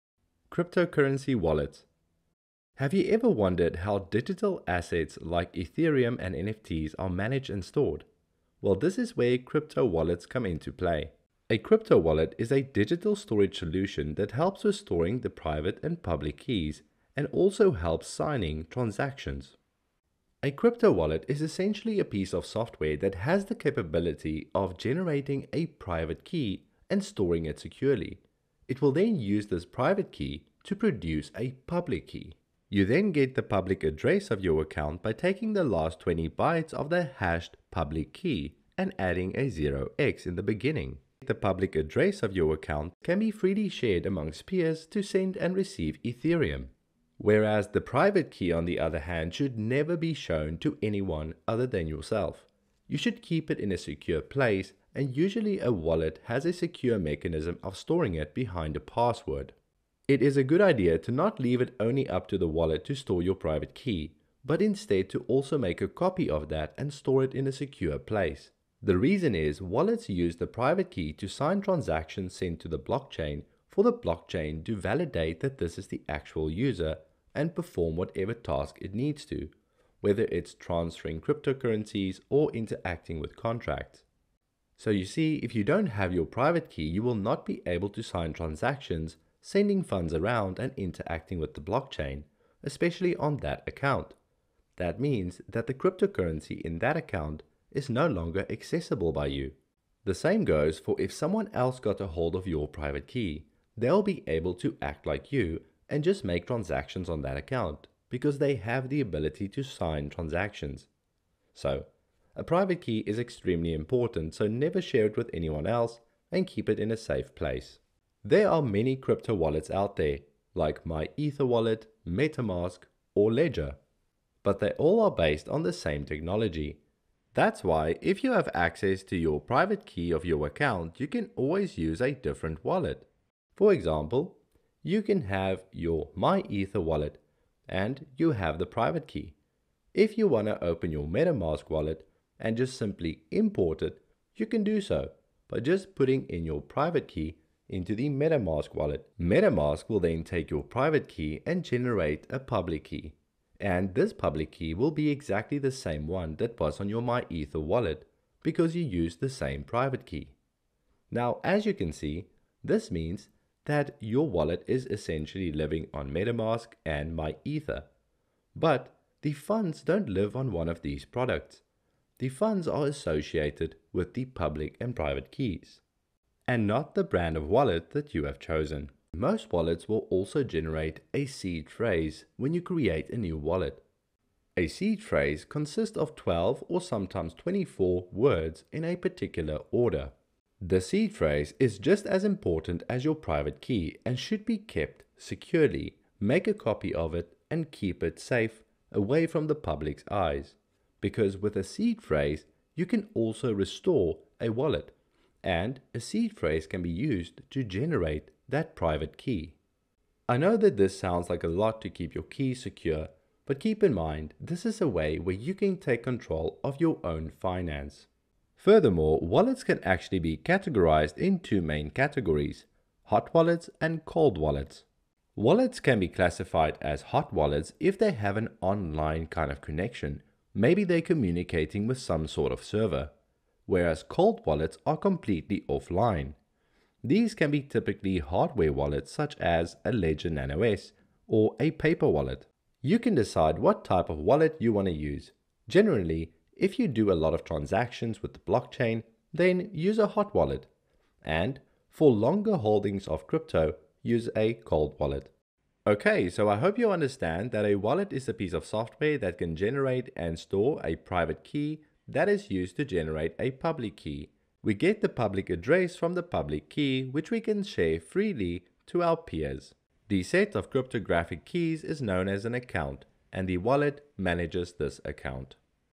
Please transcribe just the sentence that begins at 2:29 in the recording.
MetaMask will then take your private key and generate a public key.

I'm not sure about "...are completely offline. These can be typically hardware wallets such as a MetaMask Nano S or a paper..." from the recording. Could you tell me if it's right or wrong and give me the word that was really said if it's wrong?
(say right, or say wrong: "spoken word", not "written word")
wrong: "Ledger", not "MetaMask".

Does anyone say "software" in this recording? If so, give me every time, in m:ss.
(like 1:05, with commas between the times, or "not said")
0:22, 4:18.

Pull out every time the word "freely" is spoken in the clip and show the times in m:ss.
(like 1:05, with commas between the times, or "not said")
0:43, 4:27.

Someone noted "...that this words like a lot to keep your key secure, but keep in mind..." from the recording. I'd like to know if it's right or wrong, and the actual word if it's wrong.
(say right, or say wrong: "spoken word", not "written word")
wrong: "sounds", not "words".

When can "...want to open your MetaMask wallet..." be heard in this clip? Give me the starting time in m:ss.
2:20.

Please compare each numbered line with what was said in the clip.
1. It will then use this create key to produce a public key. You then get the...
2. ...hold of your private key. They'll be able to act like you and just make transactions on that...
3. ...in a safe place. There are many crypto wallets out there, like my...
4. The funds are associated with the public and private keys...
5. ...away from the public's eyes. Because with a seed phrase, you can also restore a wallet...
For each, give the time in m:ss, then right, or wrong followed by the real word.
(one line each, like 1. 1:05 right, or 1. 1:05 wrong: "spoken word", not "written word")
1. 0:28 wrong: "private", not "create"
2. 1:42 right
3. 1:56 right
4. 2:52 right
5. 3:18 right.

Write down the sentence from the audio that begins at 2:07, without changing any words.
That's why if you have access to your private key of your account, you can always use a different wallet.